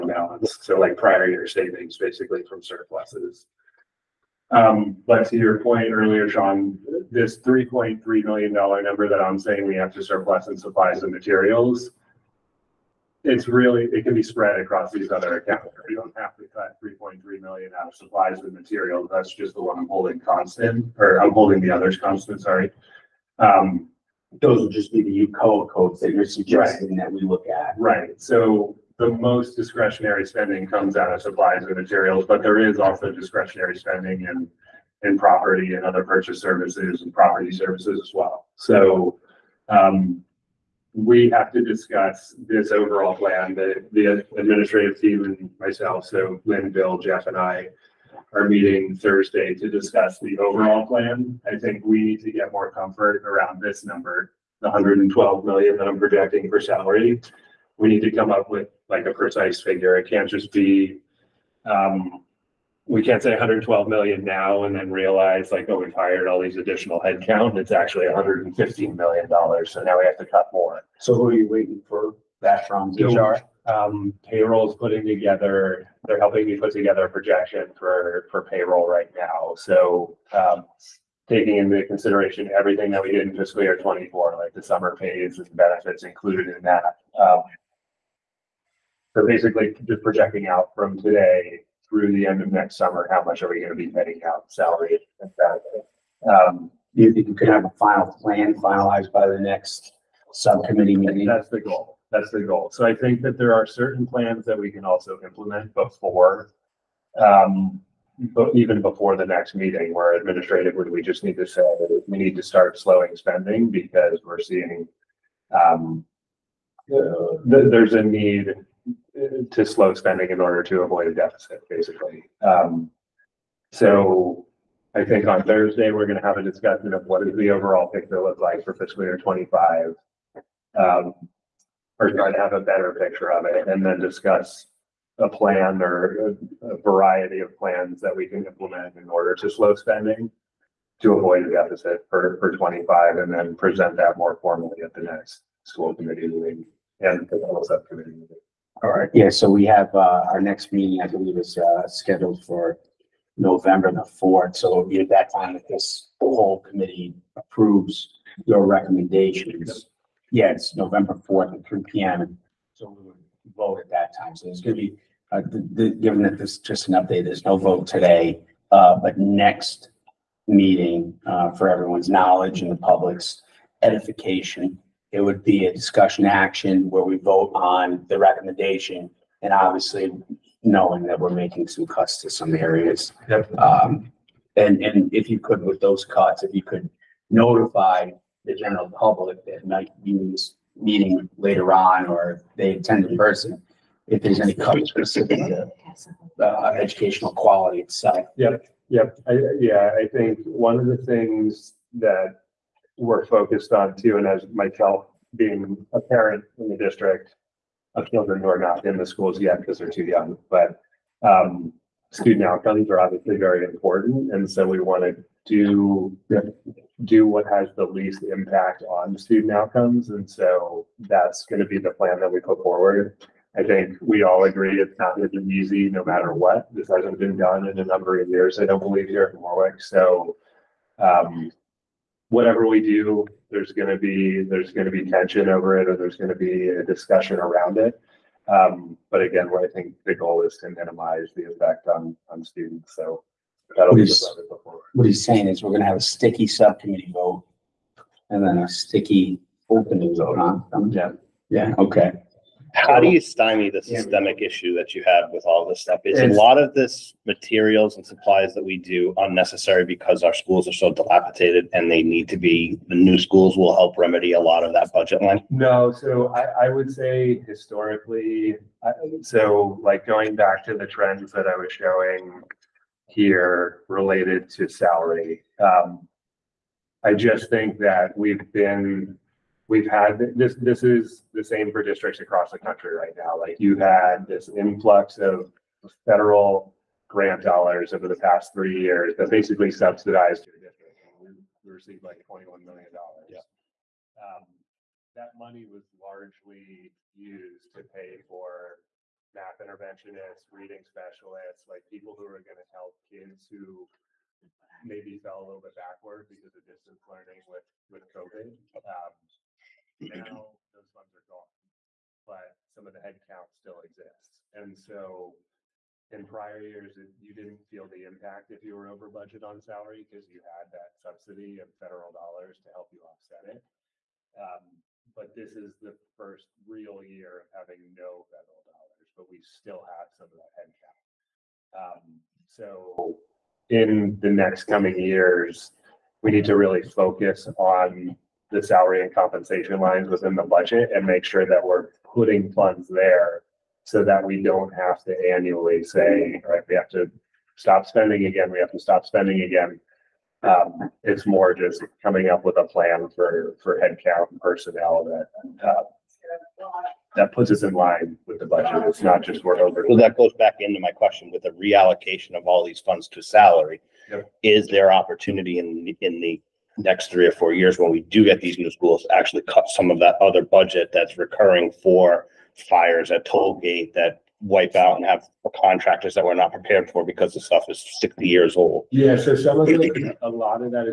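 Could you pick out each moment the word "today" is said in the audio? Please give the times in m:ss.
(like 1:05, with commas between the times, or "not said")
1:31, 2:47.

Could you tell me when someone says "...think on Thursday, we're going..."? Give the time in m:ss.
2:05.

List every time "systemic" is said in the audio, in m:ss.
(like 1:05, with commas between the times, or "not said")
4:13.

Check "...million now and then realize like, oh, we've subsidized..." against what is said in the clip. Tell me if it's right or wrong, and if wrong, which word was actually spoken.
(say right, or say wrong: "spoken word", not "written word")
wrong: "hired", not "subsidized".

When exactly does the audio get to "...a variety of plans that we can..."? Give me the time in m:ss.
2:16.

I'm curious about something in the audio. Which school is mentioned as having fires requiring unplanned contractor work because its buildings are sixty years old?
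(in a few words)
Toll Gate.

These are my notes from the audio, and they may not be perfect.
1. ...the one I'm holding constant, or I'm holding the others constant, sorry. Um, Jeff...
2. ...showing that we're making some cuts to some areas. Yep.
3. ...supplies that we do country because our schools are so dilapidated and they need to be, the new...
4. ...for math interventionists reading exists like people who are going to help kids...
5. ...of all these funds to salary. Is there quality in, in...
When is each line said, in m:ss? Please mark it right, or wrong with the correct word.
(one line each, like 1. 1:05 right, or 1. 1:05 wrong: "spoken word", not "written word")
1. 0:19 wrong: "Those", not "Jeff"
2. 3:00 wrong: "knowing", not "showing"
3. 4:18 wrong: "unnecessary", not "country"
4. 4:58 wrong: "specialists", not "exists"
5. 6:02 wrong: "opportunity", not "quality".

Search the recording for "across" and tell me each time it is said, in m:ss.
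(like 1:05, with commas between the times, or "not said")
0:14, 4:42.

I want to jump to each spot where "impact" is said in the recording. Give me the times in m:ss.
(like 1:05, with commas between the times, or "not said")
3:38, 5:18.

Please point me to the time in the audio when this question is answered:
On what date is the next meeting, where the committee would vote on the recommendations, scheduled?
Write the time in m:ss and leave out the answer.
2:33.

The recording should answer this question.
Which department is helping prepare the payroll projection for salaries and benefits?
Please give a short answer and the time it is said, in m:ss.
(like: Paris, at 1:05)
HR, at 1:12.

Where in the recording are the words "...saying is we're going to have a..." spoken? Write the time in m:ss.
4:05.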